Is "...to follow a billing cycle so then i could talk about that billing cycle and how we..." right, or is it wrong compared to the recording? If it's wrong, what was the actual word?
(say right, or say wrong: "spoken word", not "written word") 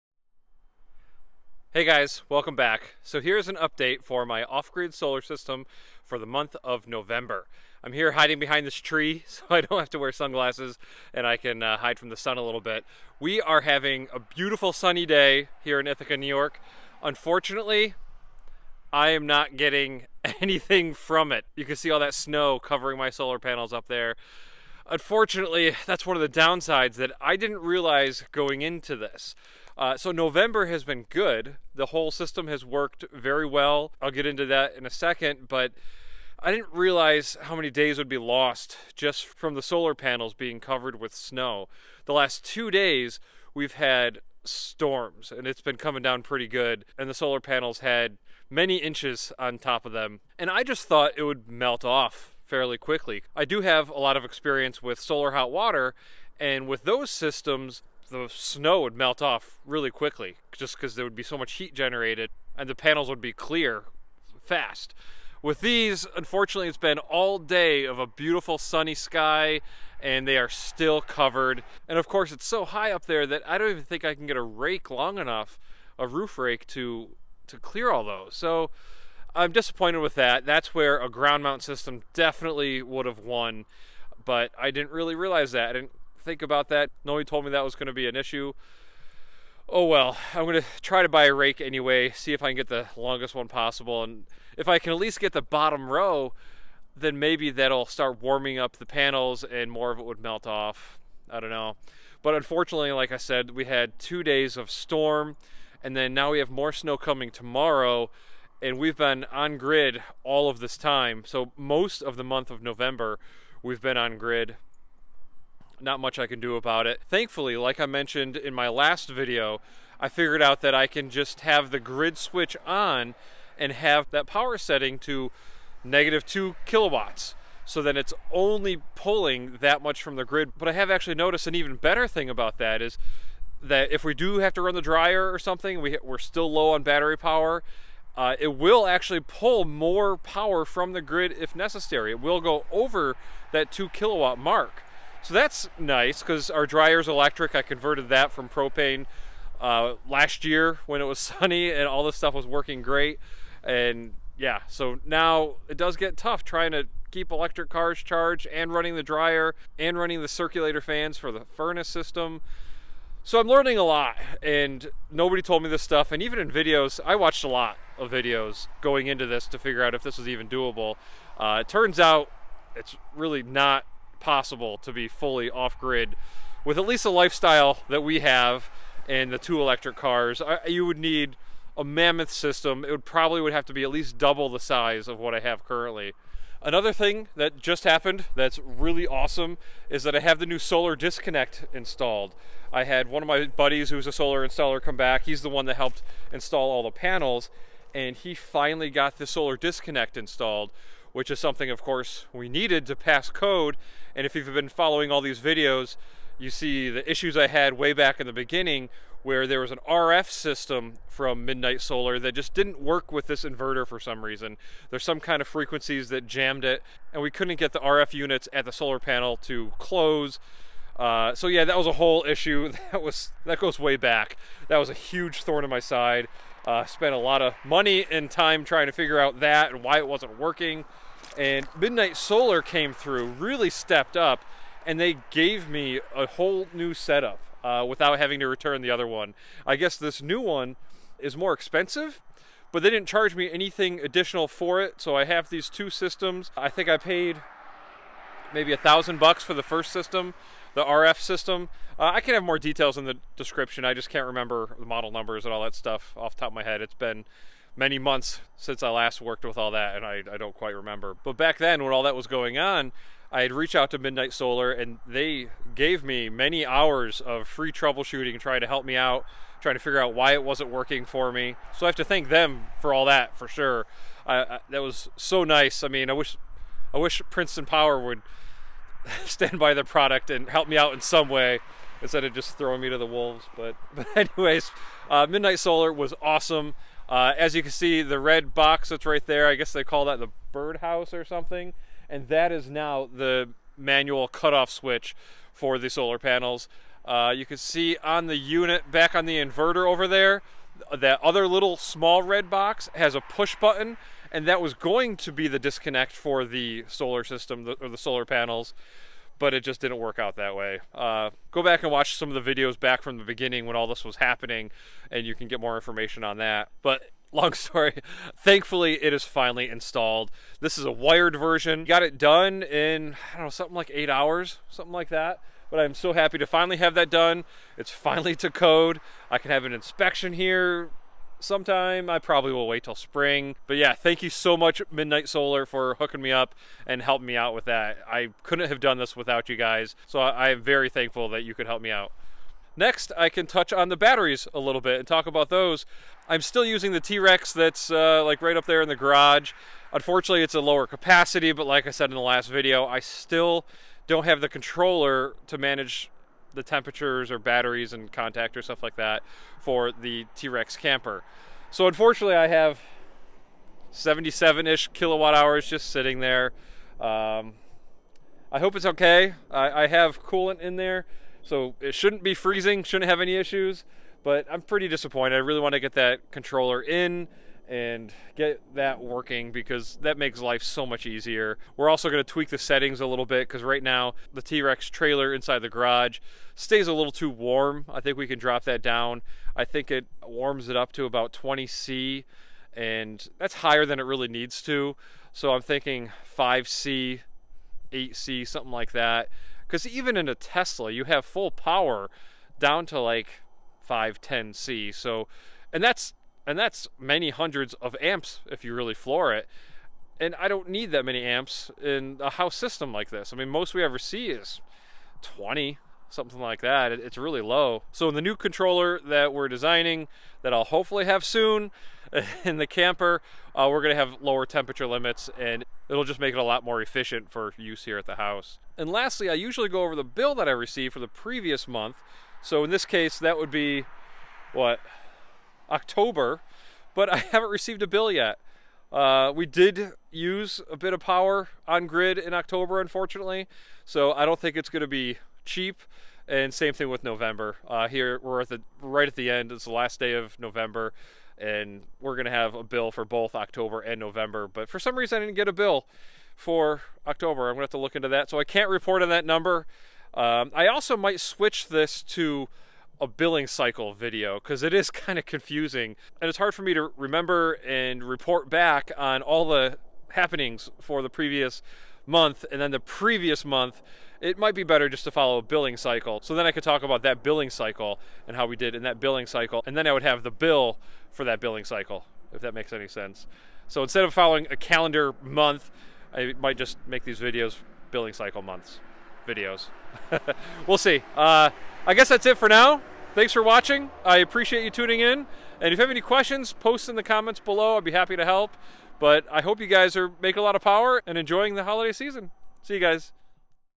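right.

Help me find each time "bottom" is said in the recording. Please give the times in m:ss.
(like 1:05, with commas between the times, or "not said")
1:35.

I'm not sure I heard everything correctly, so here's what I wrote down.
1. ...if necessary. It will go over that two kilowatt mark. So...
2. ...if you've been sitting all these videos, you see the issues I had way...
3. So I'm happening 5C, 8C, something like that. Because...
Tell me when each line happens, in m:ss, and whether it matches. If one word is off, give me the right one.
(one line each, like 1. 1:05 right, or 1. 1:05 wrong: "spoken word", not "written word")
1. 2:21 right
2. 3:24 wrong: "following", not "sitting"
3. 6:35 wrong: "thinking", not "happening".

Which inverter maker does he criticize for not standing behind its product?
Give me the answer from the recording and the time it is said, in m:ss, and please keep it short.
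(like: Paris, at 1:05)
Princeton Power, at 4:37.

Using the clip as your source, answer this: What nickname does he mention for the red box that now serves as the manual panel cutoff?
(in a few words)
the birdhouse.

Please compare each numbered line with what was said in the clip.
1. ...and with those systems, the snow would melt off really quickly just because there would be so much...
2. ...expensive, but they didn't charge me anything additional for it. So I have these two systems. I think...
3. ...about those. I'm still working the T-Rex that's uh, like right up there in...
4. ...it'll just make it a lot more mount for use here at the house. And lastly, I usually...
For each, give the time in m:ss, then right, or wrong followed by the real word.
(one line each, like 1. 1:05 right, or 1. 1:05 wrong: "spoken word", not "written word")
1. 0:56 right
2. 4:01 right
3. 5:45 wrong: "using", not "working"
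4. 7:05 wrong: "efficient", not "mount".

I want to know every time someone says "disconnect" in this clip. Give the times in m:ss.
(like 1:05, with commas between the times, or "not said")
3:10, 3:19, 5:05.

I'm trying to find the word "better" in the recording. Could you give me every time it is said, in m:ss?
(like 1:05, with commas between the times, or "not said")
2:11, 7:54.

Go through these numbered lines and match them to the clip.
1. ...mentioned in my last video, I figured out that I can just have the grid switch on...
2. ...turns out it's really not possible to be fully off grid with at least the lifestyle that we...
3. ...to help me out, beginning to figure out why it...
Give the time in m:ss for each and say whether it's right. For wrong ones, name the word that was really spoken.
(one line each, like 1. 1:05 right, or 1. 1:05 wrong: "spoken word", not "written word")
1. 1:57 right
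2. 2:51 right
3. 4:28 wrong: "trying", not "beginning".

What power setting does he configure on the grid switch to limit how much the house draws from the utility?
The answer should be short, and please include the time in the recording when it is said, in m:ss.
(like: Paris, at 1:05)
negative 2 kilowatts, at 2:05.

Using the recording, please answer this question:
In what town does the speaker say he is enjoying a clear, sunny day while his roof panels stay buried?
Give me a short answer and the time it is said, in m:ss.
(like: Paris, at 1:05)
Ithaca, New York, at 0:15.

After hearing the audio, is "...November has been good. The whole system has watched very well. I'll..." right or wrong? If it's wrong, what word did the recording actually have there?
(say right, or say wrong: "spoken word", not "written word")
wrong: "worked", not "watched".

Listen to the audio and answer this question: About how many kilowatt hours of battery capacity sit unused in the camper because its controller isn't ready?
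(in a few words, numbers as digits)
77.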